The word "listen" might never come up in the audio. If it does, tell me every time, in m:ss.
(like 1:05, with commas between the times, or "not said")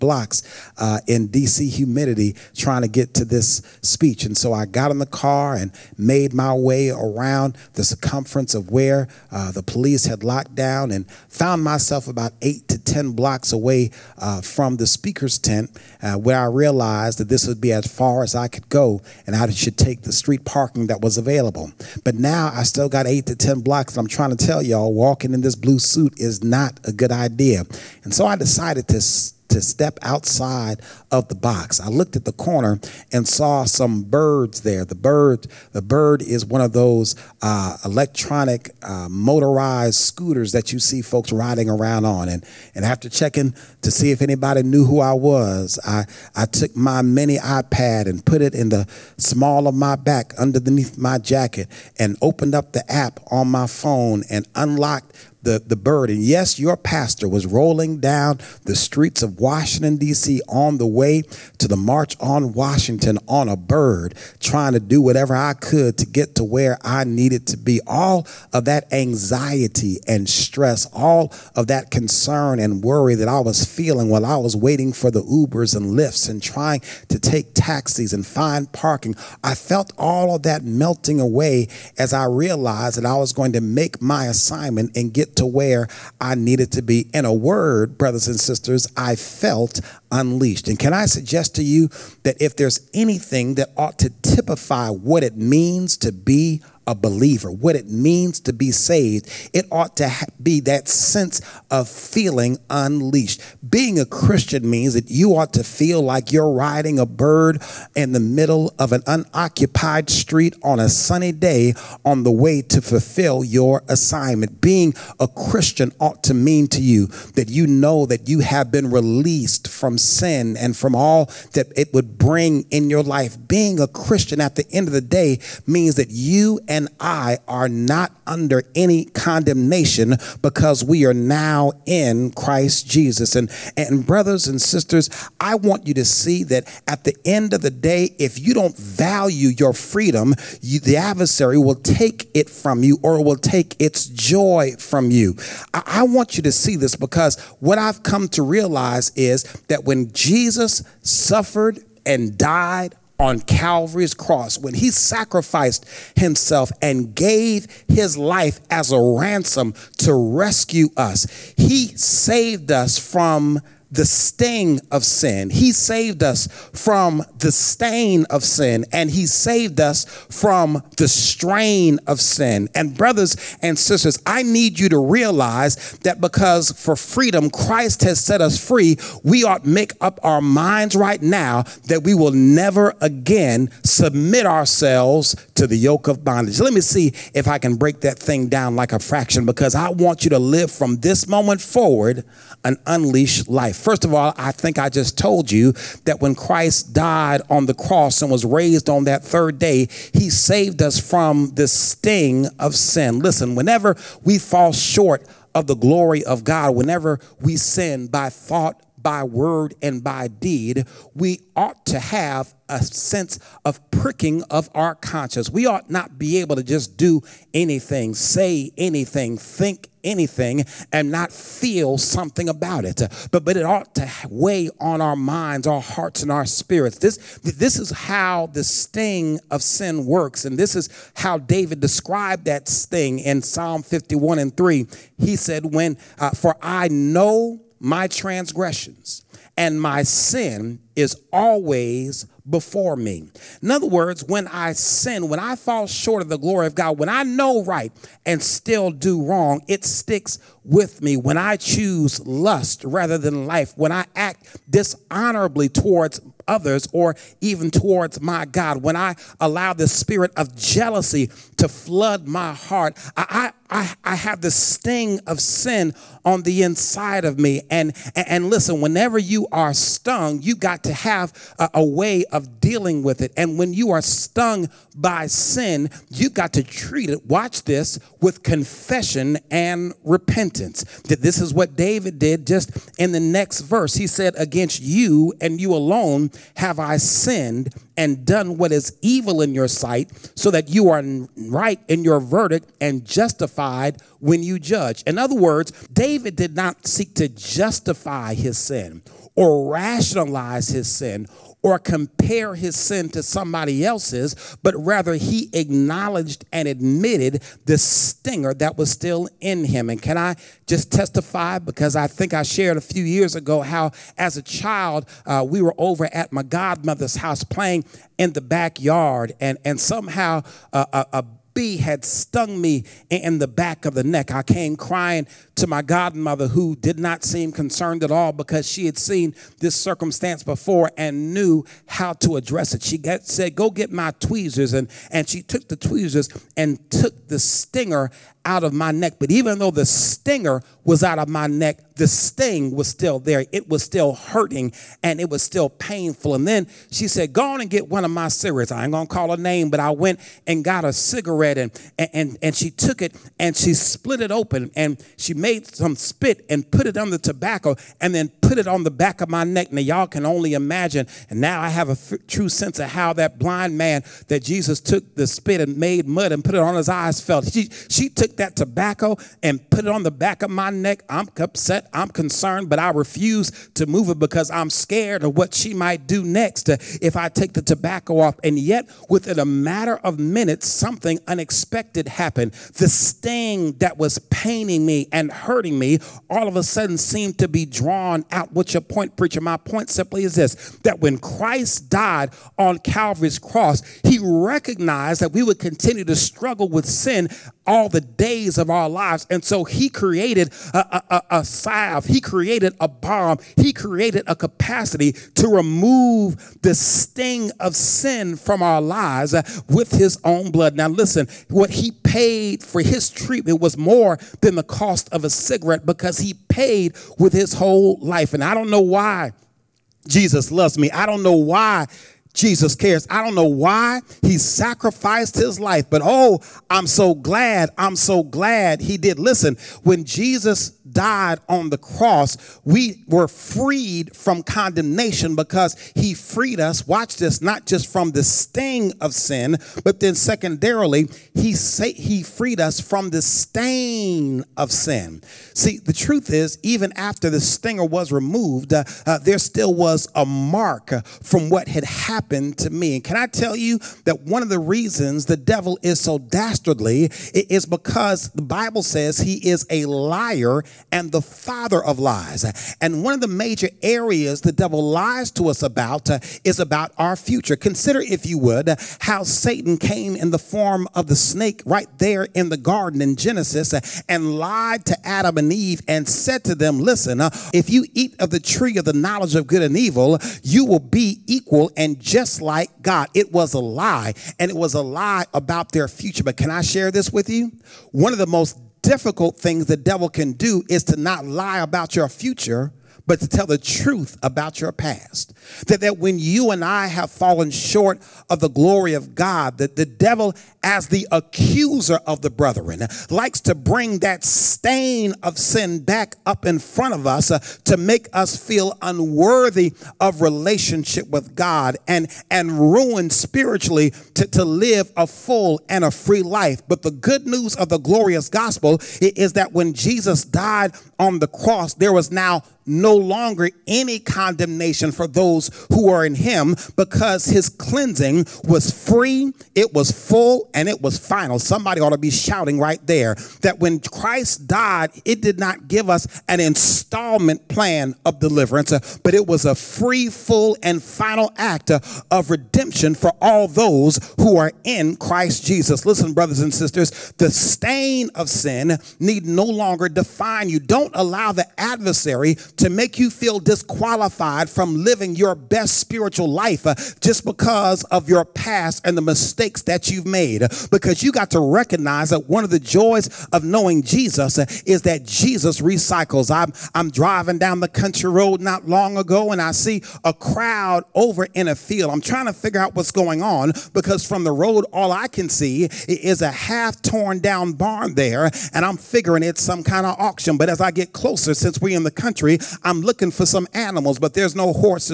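3:23, 4:28, 6:50, 7:09, 7:56, 9:05.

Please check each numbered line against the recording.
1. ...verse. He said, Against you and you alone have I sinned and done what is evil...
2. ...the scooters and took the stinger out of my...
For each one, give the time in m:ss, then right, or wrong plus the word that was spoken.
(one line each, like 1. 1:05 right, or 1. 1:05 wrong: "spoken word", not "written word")
1. 4:43 right
2. 5:35 wrong: "tweezers", not "scooters".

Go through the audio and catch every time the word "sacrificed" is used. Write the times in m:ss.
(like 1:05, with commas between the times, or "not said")
2:34, 7:04.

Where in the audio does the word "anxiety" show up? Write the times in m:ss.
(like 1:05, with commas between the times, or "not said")
1:08.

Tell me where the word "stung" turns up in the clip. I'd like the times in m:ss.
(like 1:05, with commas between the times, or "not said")
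4:29, 4:34, 5:22.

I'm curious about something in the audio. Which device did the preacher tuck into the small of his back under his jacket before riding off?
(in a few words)
Mini iPad.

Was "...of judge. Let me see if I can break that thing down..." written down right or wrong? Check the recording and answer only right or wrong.
wrong.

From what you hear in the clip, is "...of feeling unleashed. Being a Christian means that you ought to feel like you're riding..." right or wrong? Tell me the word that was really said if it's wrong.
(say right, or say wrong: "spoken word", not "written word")
right.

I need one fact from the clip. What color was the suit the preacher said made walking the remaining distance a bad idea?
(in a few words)
Blue.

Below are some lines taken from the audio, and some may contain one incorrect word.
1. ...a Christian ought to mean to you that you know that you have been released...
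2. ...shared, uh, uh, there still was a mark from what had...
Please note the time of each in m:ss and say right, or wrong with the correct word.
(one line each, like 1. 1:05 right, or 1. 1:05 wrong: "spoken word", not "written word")
1. 1:55 right
2. 7:28 wrong: "removed", not "shared".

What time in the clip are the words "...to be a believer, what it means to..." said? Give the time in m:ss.
1:35.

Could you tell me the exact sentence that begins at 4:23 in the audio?
I, I, I have the sting of sin on the inside of me.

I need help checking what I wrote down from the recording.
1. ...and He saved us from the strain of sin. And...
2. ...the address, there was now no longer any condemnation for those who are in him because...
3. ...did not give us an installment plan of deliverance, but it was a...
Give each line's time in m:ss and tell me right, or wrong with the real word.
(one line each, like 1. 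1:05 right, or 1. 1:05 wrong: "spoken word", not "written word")
1. 2:48 right
2. 8:41 wrong: "cross", not "address"
3. 8:55 right.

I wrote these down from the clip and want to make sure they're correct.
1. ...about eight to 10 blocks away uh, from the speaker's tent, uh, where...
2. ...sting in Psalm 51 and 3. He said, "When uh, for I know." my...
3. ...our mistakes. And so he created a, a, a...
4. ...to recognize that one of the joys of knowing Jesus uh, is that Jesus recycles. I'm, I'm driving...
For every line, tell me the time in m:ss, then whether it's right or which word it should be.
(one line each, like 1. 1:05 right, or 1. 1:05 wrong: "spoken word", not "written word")
1. 0:12 right
2. 3:52 right
3. 6:38 wrong: "lives", not "mistakes"
4. 9:21 right.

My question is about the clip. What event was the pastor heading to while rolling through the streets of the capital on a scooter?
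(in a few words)
March on Washington.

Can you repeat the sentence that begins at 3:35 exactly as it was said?
We ought not be able to just do anything, say anything, think anything, and not feel something about it.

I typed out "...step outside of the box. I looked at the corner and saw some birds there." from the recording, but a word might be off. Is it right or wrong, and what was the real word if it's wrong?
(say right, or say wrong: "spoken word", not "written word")
right.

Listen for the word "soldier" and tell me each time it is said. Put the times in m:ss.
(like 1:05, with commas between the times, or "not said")
not said.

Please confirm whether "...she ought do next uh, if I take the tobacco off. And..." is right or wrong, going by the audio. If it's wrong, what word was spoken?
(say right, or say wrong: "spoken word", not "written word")
wrong: "might", not "ought".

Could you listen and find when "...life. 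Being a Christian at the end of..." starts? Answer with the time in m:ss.
2:03.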